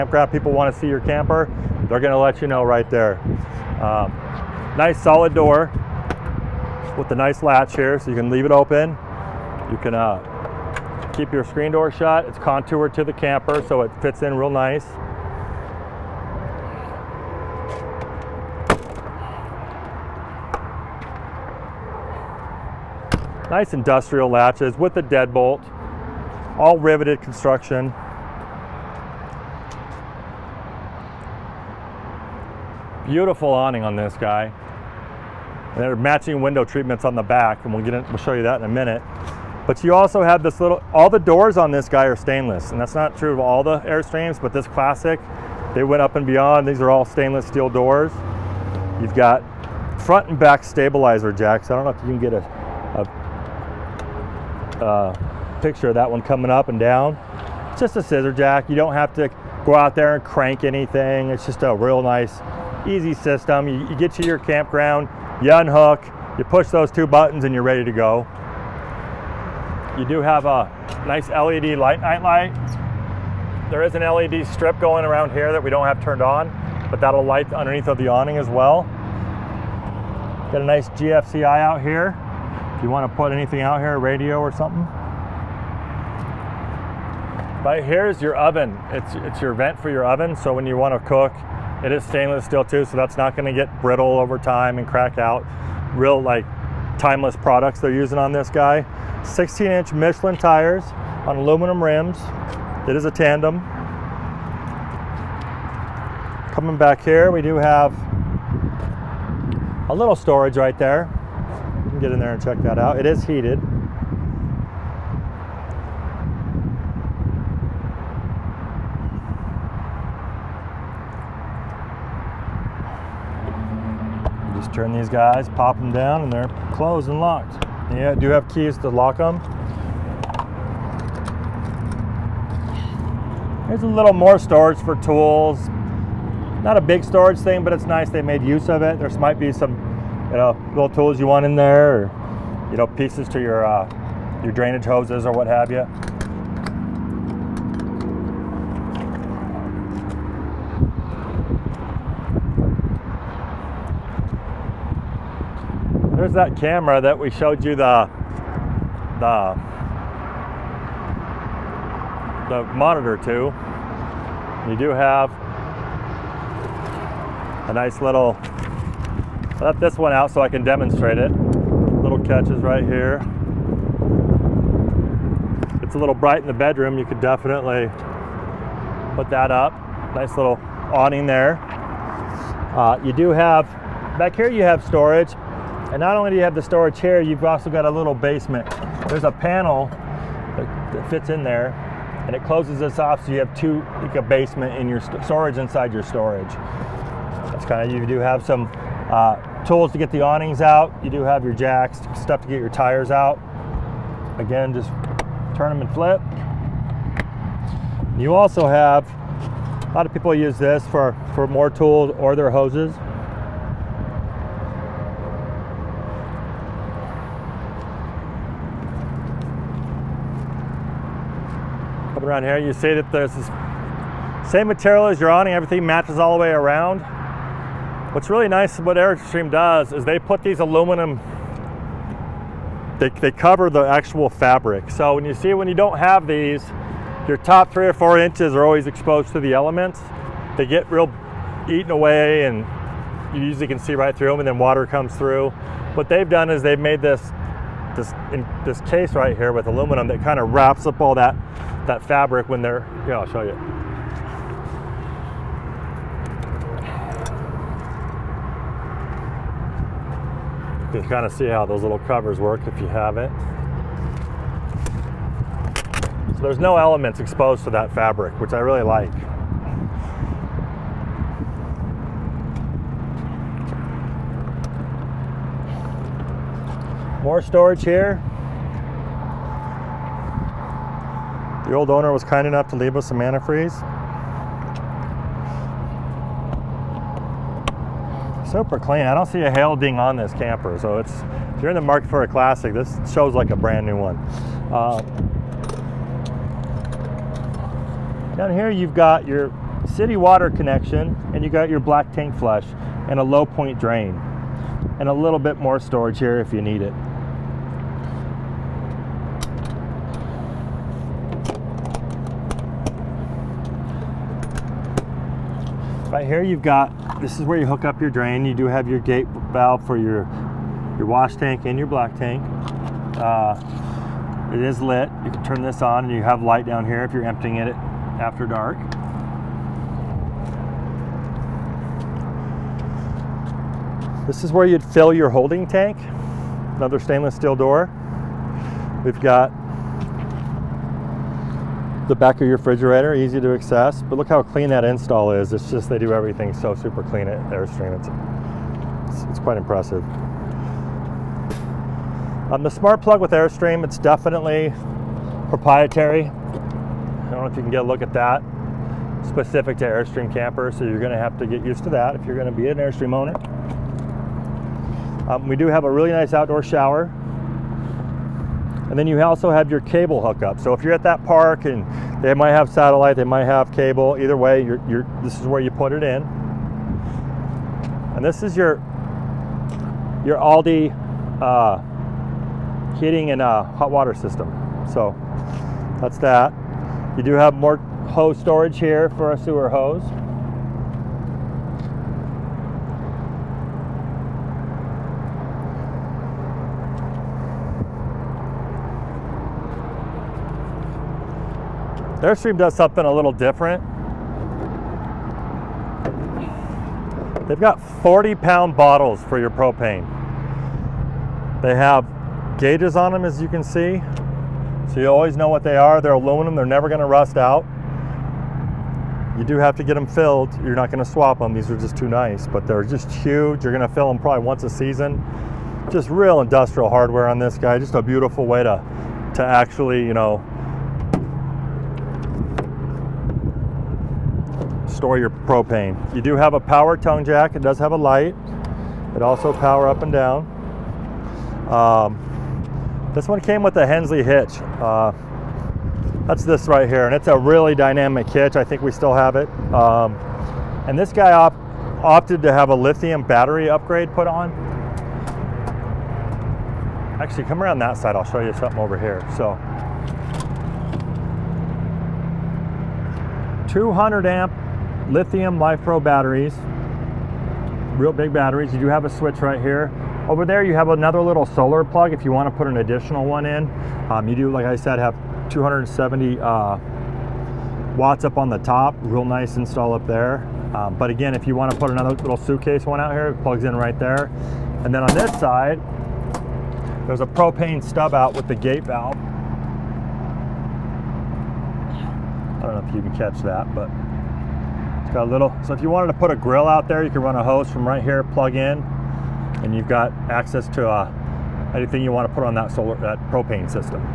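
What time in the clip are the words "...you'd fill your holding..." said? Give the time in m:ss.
5:34.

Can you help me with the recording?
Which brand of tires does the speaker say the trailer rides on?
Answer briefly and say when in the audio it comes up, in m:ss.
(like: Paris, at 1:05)
Michelin, at 1:39.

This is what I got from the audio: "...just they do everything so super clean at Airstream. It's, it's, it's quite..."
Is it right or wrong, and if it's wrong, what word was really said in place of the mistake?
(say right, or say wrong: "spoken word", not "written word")
right.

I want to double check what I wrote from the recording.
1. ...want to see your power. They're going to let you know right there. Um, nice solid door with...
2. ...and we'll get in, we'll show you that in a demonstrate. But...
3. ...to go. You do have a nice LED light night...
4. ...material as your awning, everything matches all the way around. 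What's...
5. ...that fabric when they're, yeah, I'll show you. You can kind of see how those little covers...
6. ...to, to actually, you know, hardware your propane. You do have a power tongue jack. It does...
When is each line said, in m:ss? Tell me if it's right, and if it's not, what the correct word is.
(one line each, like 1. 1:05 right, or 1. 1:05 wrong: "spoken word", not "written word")
1. 0:00 wrong: "camper", not "power"
2. 0:37 wrong: "minute", not "demonstrate"
3. 1:07 right
4. 3:44 right
5. 4:11 right
6. 7:08 wrong: "store", not "hardware".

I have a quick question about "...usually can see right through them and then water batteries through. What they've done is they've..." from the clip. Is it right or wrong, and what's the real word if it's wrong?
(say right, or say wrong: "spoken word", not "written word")
wrong: "comes", not "batteries".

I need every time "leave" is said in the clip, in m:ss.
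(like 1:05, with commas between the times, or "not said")
0:08, 4:42.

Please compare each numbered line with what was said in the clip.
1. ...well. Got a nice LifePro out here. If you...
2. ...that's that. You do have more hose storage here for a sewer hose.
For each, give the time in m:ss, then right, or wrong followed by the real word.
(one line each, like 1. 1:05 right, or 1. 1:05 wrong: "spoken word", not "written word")
1. 1:18 wrong: "GFCI", not "LifePro"
2. 6:25 right.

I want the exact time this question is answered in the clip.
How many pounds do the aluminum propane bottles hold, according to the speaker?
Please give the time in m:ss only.
6:48.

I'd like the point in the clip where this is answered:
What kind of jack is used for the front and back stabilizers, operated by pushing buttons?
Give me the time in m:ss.
0:58.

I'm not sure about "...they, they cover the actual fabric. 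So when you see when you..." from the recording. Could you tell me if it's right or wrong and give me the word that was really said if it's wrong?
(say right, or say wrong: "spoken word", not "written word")
right.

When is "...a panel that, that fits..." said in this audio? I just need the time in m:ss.
3:09.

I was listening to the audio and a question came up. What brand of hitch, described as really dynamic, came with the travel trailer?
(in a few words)
Hensley.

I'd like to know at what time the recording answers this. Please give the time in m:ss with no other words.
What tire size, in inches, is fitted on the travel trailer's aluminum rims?
1:39.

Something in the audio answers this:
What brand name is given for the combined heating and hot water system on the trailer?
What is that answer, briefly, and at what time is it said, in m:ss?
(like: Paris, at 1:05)
Alde, at 6:20.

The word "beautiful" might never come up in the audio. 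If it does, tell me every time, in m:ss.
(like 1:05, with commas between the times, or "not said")
0:33, 7:08.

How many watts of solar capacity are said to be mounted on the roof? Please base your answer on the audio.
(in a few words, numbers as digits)
270.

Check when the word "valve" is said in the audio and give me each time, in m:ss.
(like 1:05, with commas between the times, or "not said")
5:19, 8:08.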